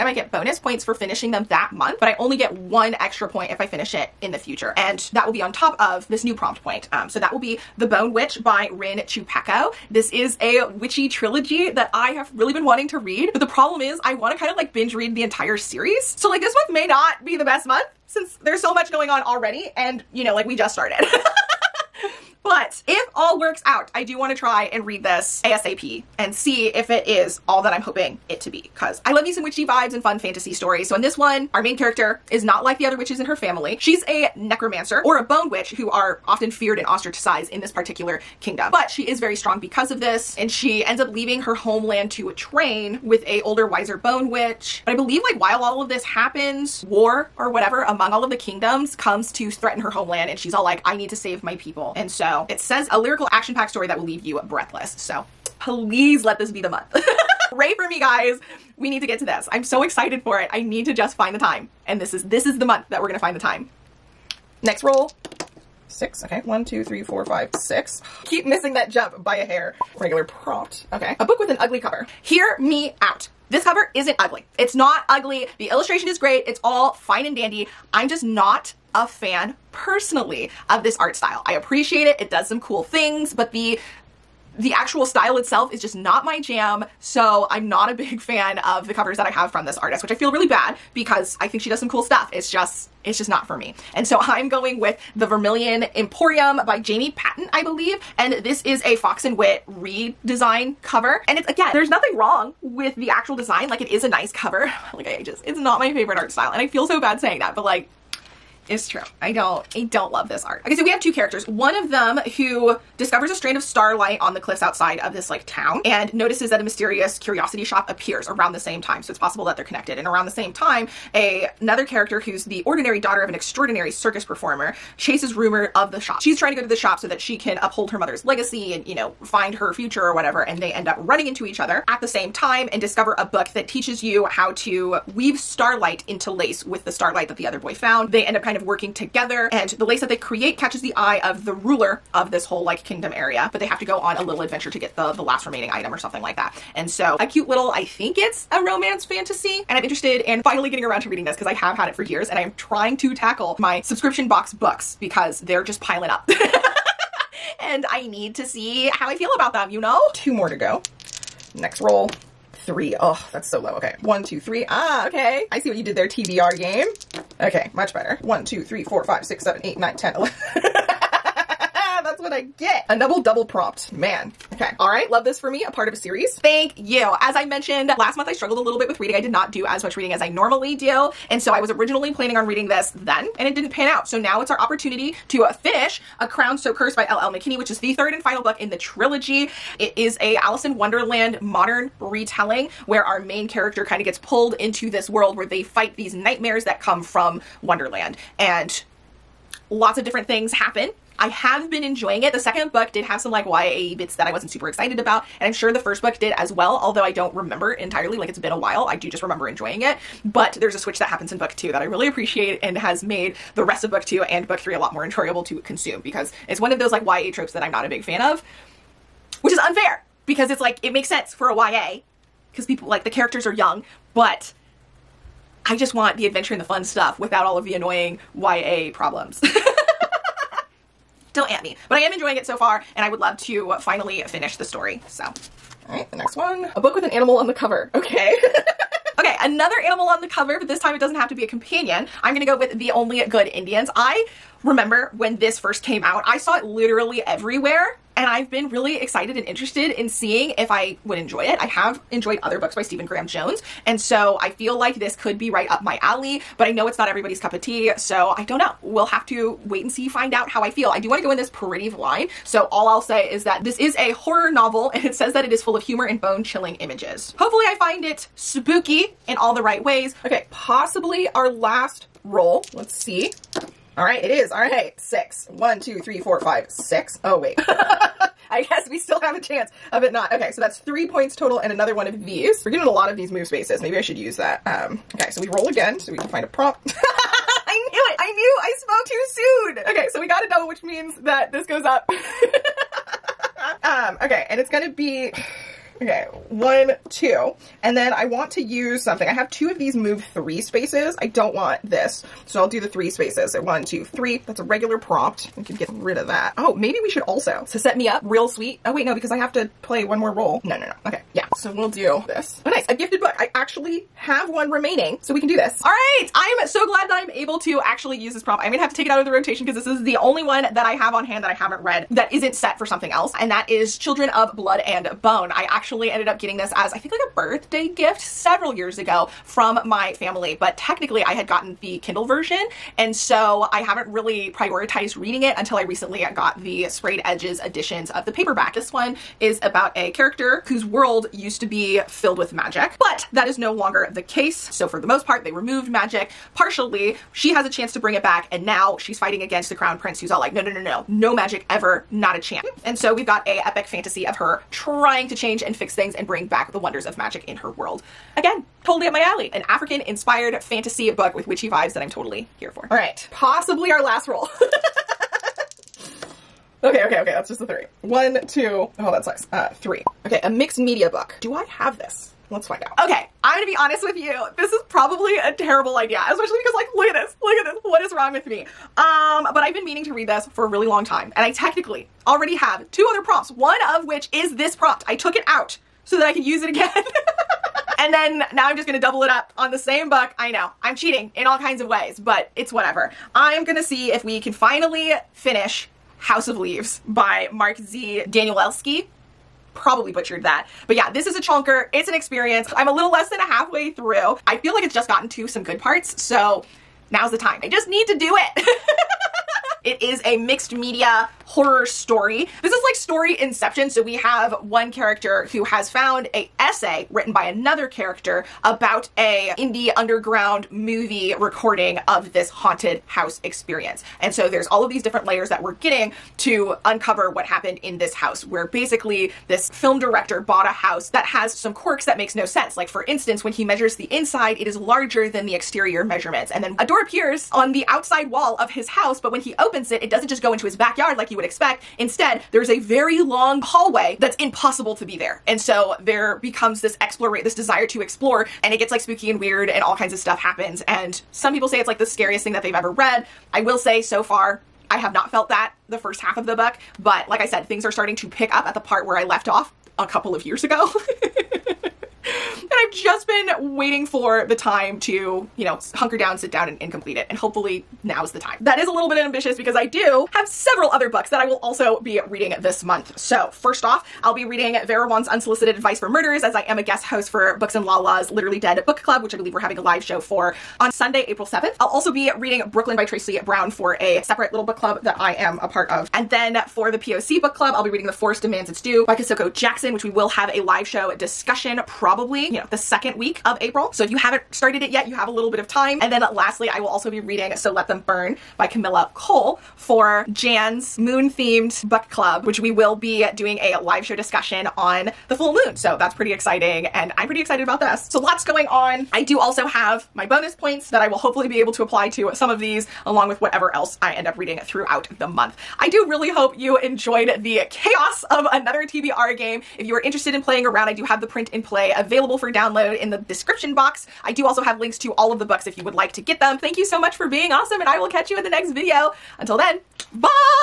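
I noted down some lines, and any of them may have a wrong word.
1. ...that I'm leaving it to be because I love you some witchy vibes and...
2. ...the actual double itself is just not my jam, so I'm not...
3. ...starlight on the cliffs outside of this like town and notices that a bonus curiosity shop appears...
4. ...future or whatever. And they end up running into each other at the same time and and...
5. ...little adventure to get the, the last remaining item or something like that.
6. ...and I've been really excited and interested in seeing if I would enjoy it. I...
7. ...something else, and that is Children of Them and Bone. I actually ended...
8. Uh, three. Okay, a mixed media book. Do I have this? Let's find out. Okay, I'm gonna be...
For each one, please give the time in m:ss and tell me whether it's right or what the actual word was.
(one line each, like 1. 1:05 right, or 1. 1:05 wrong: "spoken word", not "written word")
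1. 0:27 wrong: "hoping", not "leaving"
2. 1:24 wrong: "style", not "double"
3. 1:53 wrong: "mysterious", not "bonus"
4. 2:09 right
5. 2:24 right
6. 4:08 right
7. 5:22 wrong: "Blood", not "Them"
8. 6:09 right.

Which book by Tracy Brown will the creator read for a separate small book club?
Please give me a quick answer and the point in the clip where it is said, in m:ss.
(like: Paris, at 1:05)
Brooklyn, at 8:02.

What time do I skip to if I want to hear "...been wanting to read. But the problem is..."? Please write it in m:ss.
0:12.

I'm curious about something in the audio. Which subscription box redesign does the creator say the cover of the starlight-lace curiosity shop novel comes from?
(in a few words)
Fox and Wit.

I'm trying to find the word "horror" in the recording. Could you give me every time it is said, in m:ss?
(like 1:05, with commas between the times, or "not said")
4:24, 6:51.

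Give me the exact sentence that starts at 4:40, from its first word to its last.
Okay, so that's three points total and another one of these.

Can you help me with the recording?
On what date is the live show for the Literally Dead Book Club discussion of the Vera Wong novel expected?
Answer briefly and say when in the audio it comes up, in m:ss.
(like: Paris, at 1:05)
Sunday, April 7th, at 8:00.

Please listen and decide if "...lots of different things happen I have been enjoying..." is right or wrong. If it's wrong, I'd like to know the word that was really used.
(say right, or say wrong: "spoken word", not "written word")
right.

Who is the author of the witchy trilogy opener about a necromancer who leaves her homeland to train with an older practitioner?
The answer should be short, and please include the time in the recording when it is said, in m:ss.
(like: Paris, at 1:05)
Rin Chupeco, at 0:08.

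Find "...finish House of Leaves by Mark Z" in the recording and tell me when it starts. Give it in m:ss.
6:35.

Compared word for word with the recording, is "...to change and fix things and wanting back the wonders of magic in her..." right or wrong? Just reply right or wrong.
wrong.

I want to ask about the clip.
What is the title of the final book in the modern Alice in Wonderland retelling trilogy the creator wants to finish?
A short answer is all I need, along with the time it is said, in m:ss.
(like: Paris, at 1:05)
A Crown So Cursed, at 3:06.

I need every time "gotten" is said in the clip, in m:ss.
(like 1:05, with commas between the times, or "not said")
5:31, 6:45.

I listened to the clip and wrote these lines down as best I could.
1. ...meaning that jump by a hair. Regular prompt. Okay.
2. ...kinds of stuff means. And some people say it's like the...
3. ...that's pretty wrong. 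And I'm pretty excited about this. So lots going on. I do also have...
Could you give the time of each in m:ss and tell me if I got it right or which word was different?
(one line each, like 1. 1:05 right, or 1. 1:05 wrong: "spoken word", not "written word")
1. 1:08 wrong: "missing", not "meaning"
2. 7:29 wrong: "happens", not "means"
3. 8:25 wrong: "exciting", not "wrong".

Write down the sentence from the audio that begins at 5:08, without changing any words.
Oh wait, no, because I have to play one more role.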